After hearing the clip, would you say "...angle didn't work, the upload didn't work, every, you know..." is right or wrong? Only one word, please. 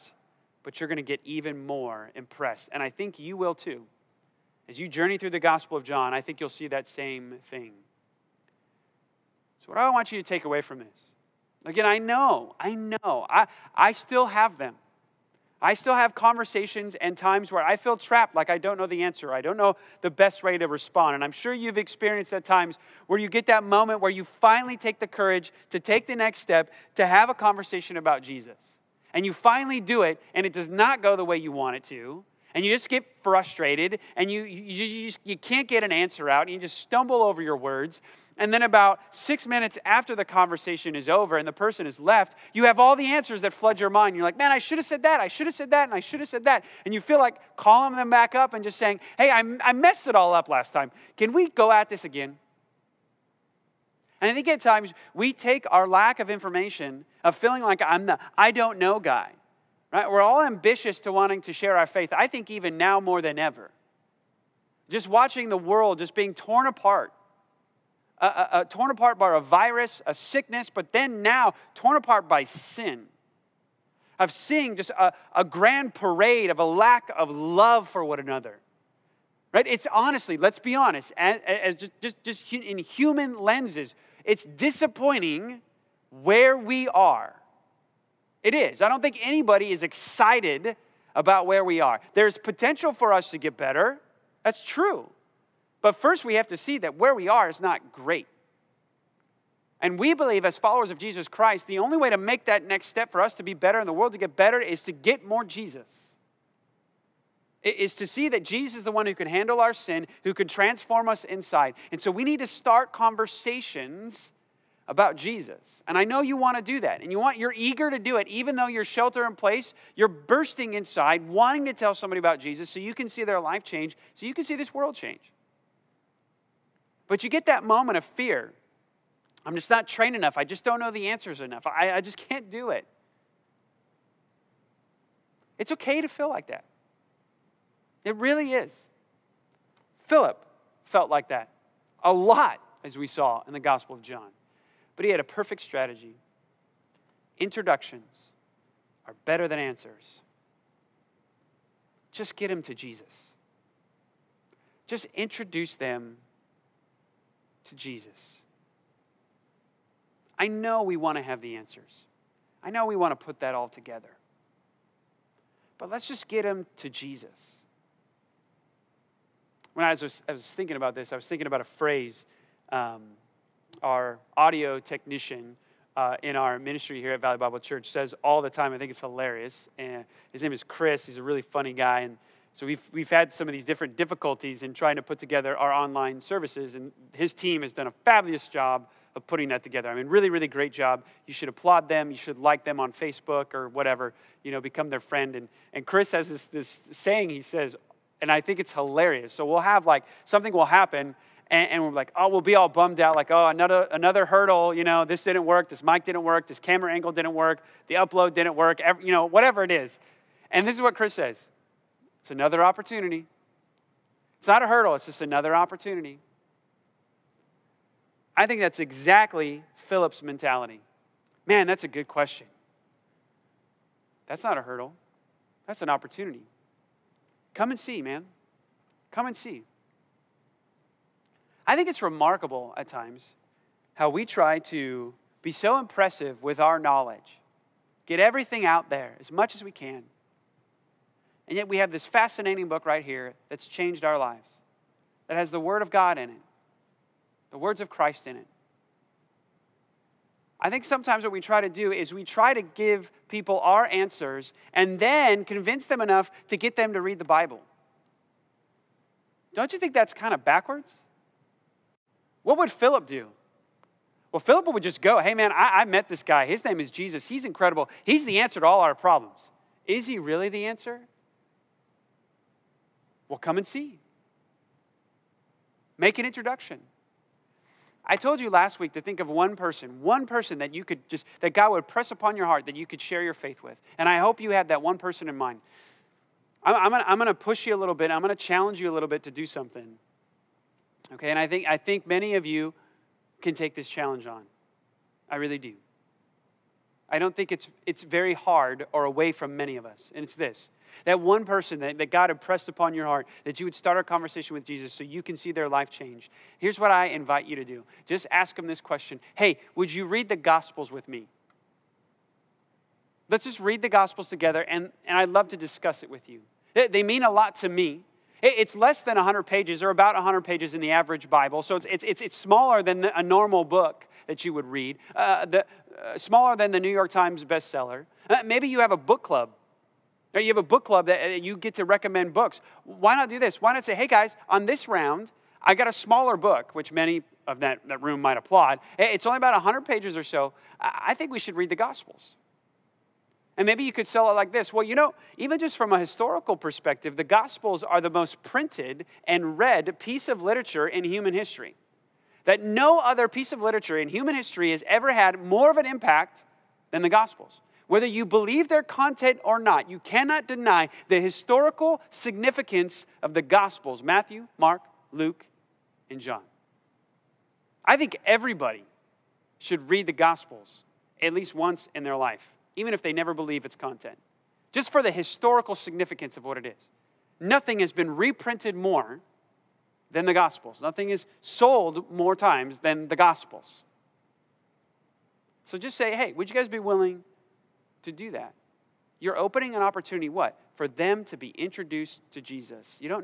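right.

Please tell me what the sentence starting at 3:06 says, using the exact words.
And his team has done a fabulous job of putting that together.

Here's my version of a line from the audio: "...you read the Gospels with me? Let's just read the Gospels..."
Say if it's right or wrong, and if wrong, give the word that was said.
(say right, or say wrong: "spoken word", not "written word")
right.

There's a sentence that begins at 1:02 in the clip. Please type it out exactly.
I think even now more than ever.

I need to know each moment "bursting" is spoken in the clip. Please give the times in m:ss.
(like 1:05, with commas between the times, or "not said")
2:00.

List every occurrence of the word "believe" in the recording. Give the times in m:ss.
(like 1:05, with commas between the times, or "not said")
1:40, 5:58, 6:13.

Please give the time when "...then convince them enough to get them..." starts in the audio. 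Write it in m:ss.
4:14.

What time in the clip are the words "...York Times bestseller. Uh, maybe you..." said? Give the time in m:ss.
5:26.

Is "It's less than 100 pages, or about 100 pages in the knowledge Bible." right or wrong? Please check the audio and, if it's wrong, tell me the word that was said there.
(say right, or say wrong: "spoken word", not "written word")
wrong: "average", not "knowledge".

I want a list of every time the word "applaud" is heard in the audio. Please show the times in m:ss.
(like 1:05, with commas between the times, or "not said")
3:11, 5:38.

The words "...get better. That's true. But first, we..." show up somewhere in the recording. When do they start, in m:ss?
1:33.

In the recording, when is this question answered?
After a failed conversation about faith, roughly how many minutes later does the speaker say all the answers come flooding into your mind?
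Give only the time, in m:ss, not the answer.
0:39.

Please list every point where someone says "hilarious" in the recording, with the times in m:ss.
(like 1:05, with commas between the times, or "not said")
2:58, 3:18.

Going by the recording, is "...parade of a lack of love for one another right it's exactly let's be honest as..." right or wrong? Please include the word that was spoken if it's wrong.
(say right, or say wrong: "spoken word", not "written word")
wrong: "honestly", not "exactly".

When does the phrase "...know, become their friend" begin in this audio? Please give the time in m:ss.
3:14.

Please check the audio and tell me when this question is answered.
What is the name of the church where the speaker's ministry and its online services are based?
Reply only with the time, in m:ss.
2:57.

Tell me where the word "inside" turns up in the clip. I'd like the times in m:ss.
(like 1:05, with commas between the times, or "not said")
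1:51, 2:00.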